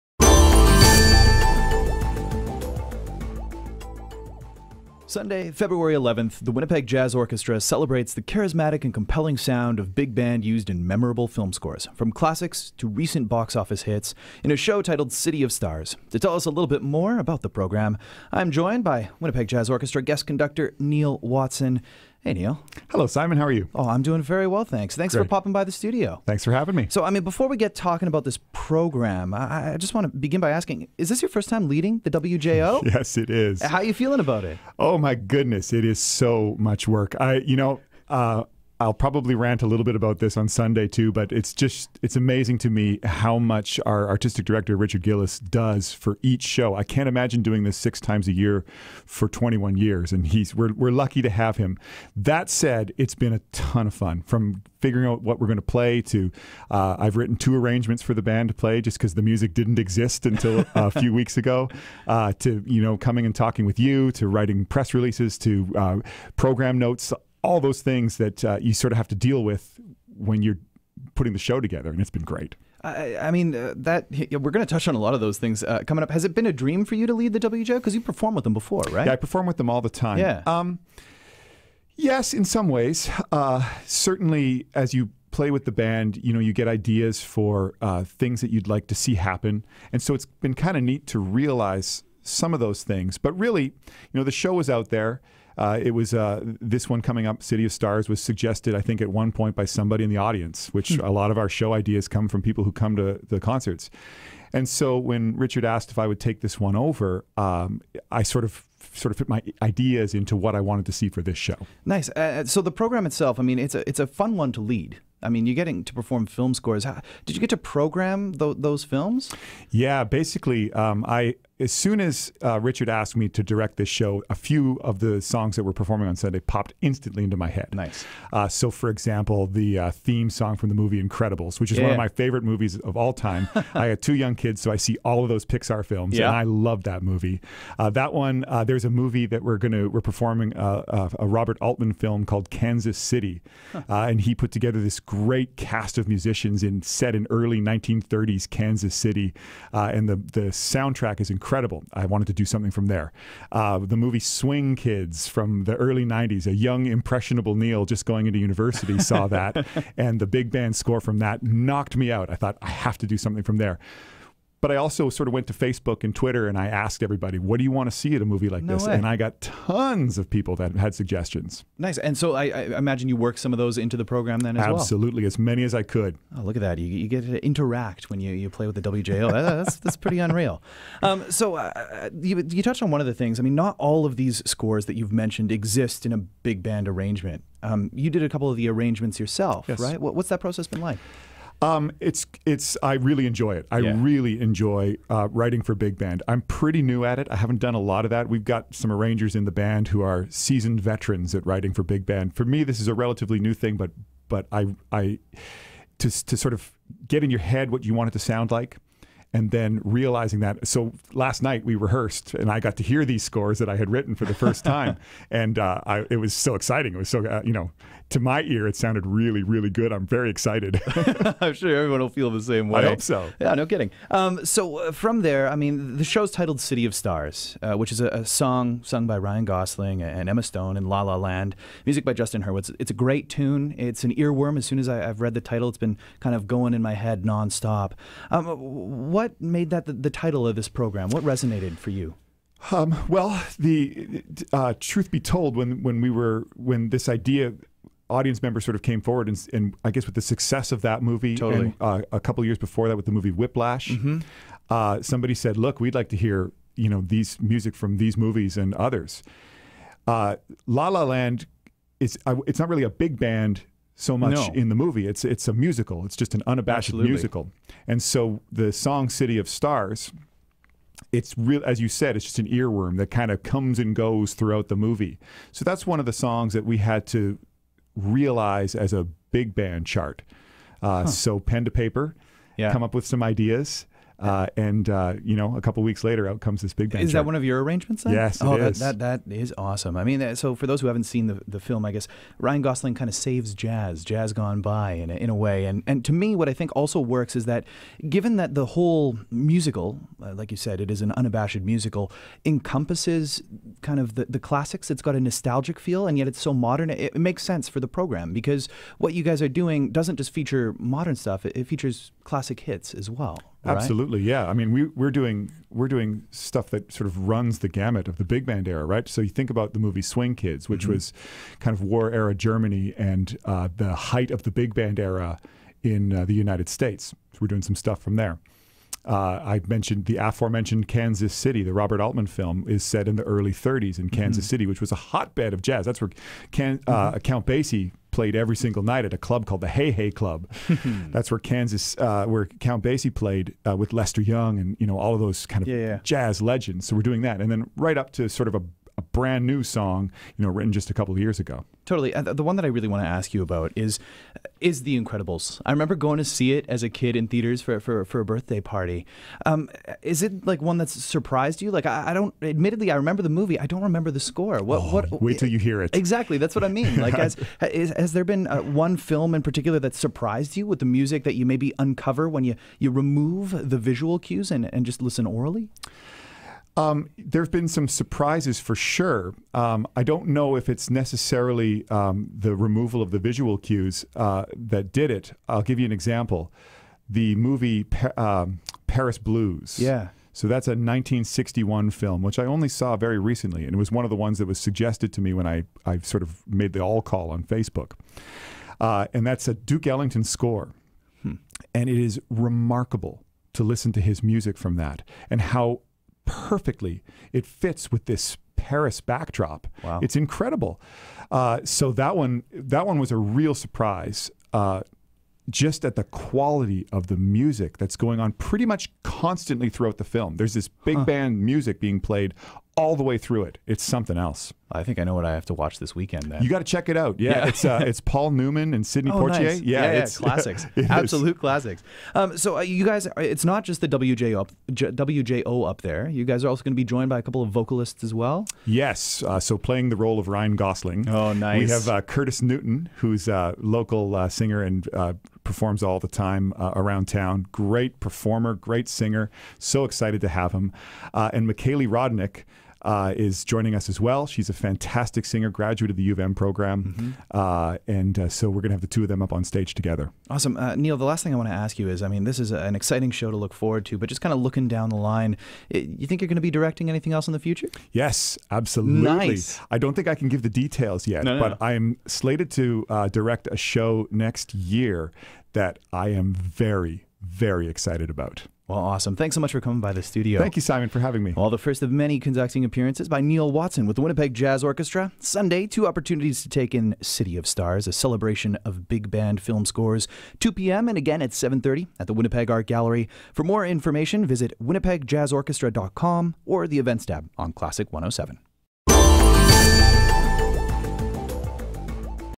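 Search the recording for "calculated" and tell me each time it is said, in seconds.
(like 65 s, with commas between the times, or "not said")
not said.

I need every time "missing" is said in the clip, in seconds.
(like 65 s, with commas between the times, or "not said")
not said.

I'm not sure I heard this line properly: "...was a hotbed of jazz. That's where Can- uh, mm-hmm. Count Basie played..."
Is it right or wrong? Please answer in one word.
right.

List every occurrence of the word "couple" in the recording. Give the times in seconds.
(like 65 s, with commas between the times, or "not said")
188 s, 252 s, 285 s, 350 s, 437 s.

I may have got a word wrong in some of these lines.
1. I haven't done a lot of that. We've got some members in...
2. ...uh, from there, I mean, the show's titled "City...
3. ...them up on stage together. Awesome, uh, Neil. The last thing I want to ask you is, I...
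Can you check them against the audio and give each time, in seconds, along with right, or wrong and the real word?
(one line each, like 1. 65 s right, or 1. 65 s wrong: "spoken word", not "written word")
1. 197 s wrong: "arrangers", not "members"
2. 224 s right
3. 459 s right.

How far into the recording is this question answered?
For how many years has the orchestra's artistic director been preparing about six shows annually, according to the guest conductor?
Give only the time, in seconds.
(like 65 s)
49 s.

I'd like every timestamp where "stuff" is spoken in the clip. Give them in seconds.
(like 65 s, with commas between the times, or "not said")
311 s, 316 s, 327 s.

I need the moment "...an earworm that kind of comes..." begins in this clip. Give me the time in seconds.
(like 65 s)
272 s.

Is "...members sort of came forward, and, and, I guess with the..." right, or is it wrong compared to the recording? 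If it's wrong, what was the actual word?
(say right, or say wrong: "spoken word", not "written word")
right.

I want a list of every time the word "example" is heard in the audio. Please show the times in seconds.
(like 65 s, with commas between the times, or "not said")
128 s, 385 s.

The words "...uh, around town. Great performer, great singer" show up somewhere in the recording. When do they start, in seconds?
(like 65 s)
446 s.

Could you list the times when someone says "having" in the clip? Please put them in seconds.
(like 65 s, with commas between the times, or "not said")
26 s, 481 s.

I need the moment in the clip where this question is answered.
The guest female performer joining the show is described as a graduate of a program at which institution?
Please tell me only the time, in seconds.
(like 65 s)
456 s.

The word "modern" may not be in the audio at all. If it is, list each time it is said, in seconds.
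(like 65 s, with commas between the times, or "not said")
306 s, 310 s.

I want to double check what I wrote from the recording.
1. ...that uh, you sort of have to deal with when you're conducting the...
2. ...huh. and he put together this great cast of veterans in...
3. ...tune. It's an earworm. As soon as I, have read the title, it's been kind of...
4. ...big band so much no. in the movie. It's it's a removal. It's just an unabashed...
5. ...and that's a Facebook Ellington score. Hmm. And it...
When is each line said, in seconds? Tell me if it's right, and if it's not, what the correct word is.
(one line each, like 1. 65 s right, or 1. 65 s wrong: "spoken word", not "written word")
1. 68 s wrong: "putting", not "conducting"
2. 143 s wrong: "musicians", not "veterans"
3. 233 s right
4. 263 s wrong: "musical", not "removal"
5. 399 s wrong: "Duke", not "Facebook".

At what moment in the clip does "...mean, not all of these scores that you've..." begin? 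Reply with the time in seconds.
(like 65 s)
183 s.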